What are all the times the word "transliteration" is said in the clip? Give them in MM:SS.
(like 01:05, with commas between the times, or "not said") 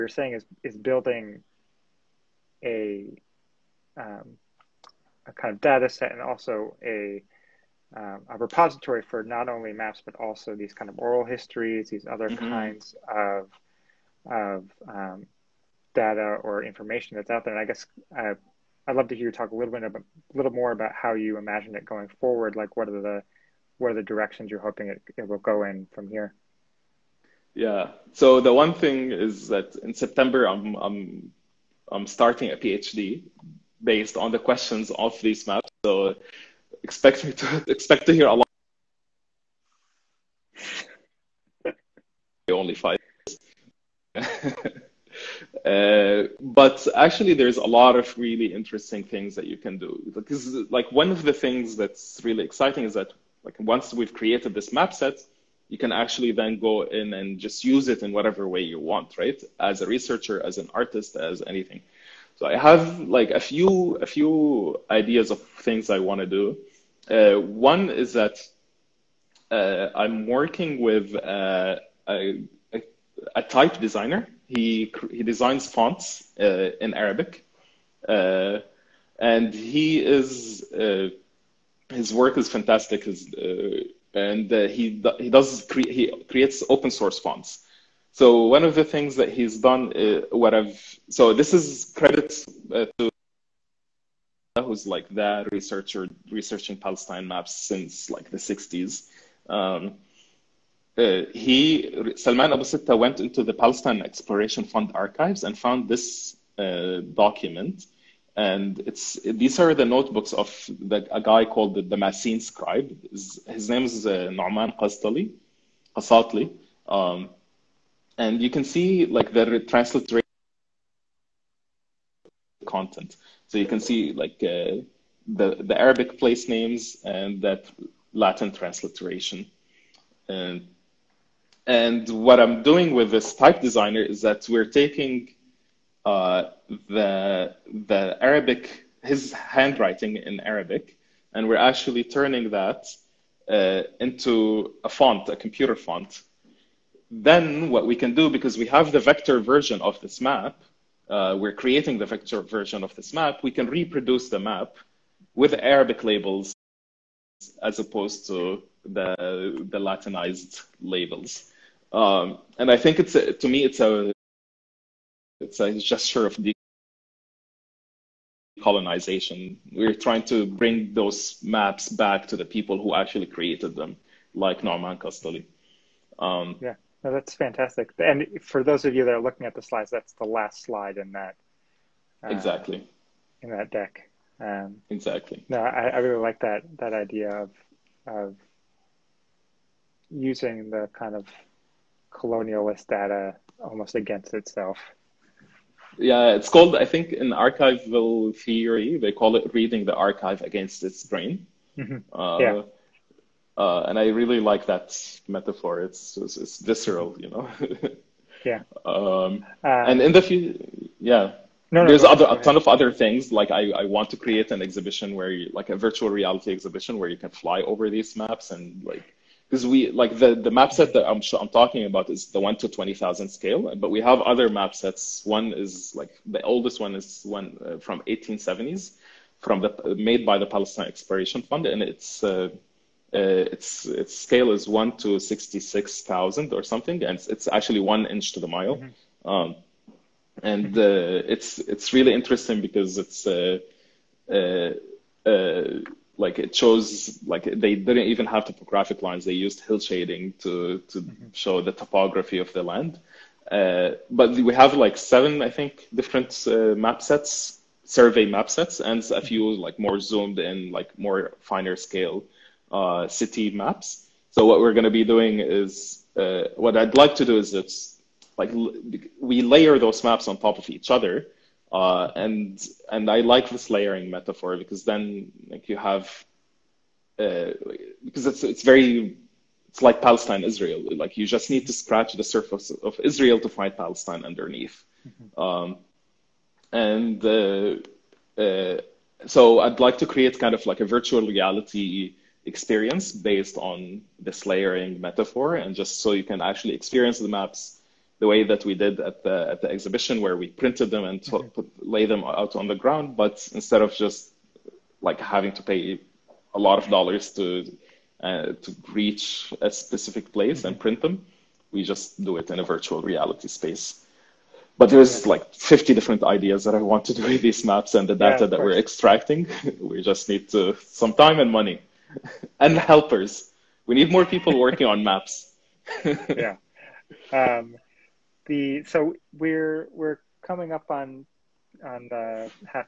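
01:59, 02:08.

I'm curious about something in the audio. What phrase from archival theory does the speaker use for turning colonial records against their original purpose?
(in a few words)
reading the archive against its grain.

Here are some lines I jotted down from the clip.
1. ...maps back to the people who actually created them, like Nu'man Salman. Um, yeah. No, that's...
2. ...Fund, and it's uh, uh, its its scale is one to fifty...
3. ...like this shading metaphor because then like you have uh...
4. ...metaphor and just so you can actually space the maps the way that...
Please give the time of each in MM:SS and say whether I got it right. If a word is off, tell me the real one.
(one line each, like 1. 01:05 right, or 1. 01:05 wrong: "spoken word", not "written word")
1. 02:51 wrong: "Qasatli", not "Salman"
2. 03:51 wrong: "sixty", not "fifty"
3. 04:33 wrong: "layering", not "shading"
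4. 04:55 wrong: "experience", not "space".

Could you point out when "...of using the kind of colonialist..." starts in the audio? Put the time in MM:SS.
03:08.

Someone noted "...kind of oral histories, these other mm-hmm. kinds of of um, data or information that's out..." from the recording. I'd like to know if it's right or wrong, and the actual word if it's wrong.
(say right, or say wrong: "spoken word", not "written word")
right.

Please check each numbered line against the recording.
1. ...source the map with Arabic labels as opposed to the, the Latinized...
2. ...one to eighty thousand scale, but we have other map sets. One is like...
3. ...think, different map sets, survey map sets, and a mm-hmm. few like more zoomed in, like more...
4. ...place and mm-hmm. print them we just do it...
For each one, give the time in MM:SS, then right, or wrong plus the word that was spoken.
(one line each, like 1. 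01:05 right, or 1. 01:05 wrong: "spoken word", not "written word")
1. 02:33 wrong: "reproduce", not "source"
2. 03:42 wrong: "twenty", not "eighty"
3. 04:15 right
4. 05:10 right.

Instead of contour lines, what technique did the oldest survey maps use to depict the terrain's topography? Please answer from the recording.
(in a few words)
hill shading.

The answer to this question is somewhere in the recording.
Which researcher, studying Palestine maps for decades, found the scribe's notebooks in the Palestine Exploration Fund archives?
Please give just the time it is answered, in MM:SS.
01:42.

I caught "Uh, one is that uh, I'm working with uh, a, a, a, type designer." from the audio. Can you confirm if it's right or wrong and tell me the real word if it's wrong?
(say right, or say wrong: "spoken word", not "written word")
right.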